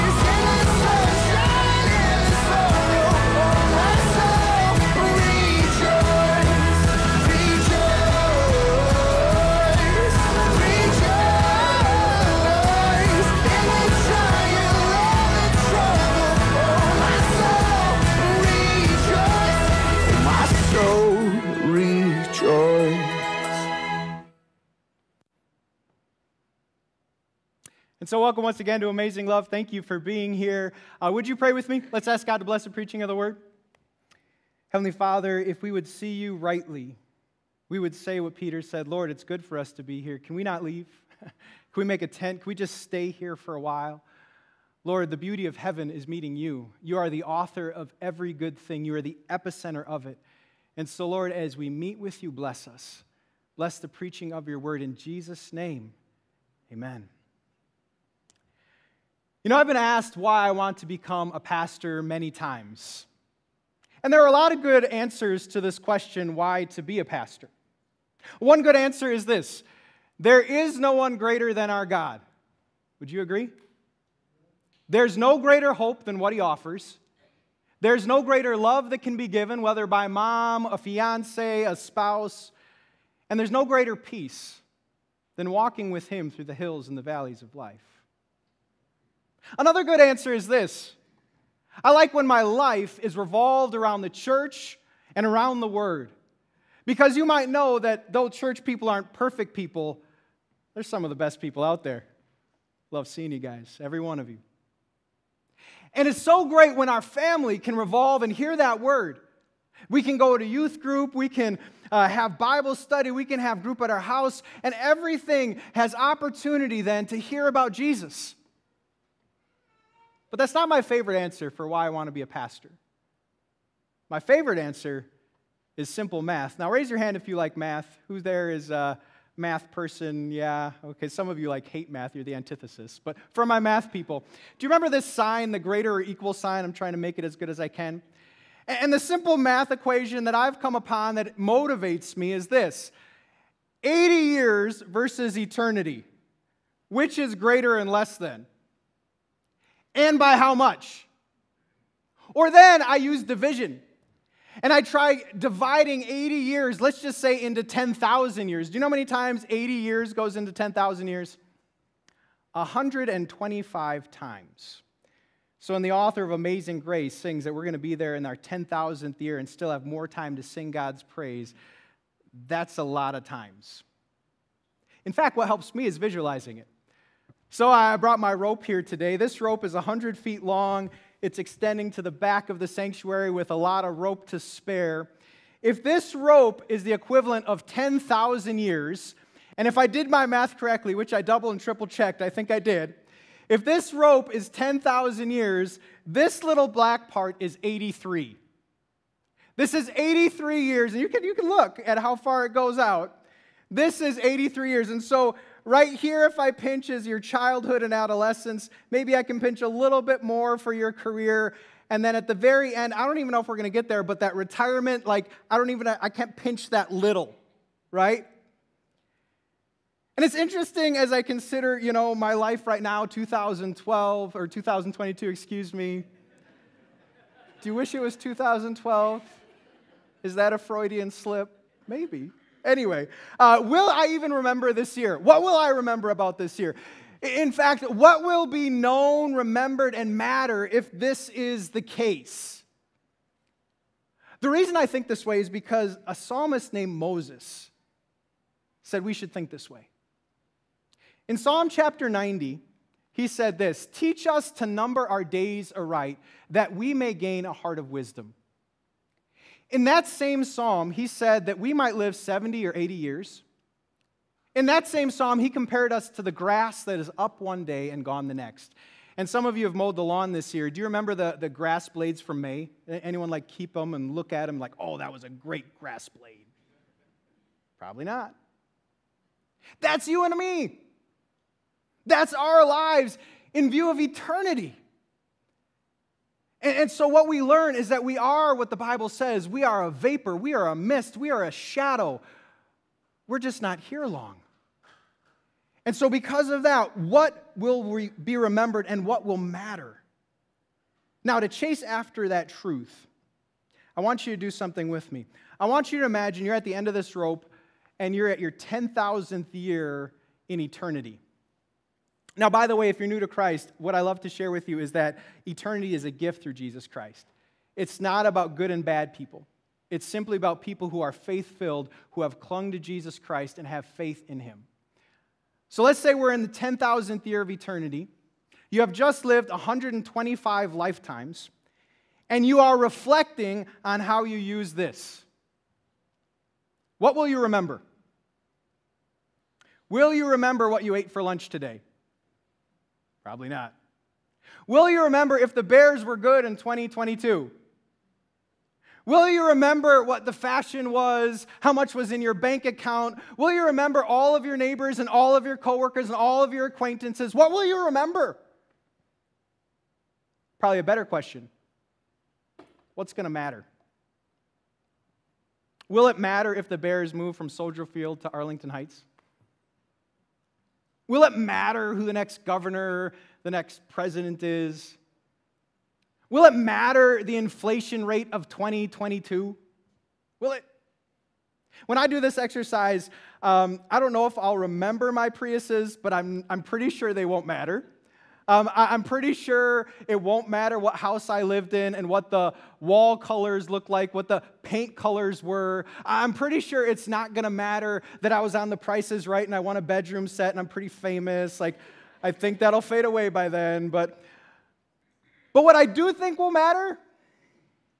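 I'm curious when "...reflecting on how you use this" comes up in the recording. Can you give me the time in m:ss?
5:32.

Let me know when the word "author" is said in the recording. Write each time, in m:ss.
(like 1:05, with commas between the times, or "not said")
0:47, 2:45.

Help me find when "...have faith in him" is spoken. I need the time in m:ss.
5:23.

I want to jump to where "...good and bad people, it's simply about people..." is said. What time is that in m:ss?
5:18.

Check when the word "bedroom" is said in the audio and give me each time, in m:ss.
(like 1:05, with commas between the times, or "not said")
6:39.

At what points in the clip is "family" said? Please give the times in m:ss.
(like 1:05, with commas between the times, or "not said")
1:47.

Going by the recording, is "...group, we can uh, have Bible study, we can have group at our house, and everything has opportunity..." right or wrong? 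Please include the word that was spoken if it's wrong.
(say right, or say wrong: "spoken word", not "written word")
right.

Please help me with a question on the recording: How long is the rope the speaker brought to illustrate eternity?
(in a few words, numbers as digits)
100 feet.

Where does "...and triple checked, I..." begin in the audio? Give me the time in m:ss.
3:11.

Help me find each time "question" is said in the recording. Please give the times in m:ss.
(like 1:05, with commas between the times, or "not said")
1:05, 6:01.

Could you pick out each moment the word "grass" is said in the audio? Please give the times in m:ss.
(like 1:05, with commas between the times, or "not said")
4:26, 4:31, 4:35.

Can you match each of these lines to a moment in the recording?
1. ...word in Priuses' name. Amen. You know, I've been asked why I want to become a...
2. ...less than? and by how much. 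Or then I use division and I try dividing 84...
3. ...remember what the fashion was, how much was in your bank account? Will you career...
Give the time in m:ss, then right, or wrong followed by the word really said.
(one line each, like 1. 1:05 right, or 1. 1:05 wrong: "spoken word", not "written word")
1. 0:54 wrong: "Jesus", not "Priuses"
2. 2:27 wrong: "80", not "84"
3. 5:49 wrong: "remember", not "career".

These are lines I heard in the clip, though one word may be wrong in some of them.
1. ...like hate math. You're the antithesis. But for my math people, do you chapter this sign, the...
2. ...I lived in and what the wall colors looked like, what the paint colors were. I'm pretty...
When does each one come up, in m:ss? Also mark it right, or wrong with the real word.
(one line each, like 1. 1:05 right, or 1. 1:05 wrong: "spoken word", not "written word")
1. 2:11 wrong: "remember", not "chapter"
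2. 6:31 right.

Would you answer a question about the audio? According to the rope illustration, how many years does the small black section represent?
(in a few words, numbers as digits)
83.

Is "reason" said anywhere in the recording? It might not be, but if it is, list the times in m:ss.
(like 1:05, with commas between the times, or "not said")
4:04.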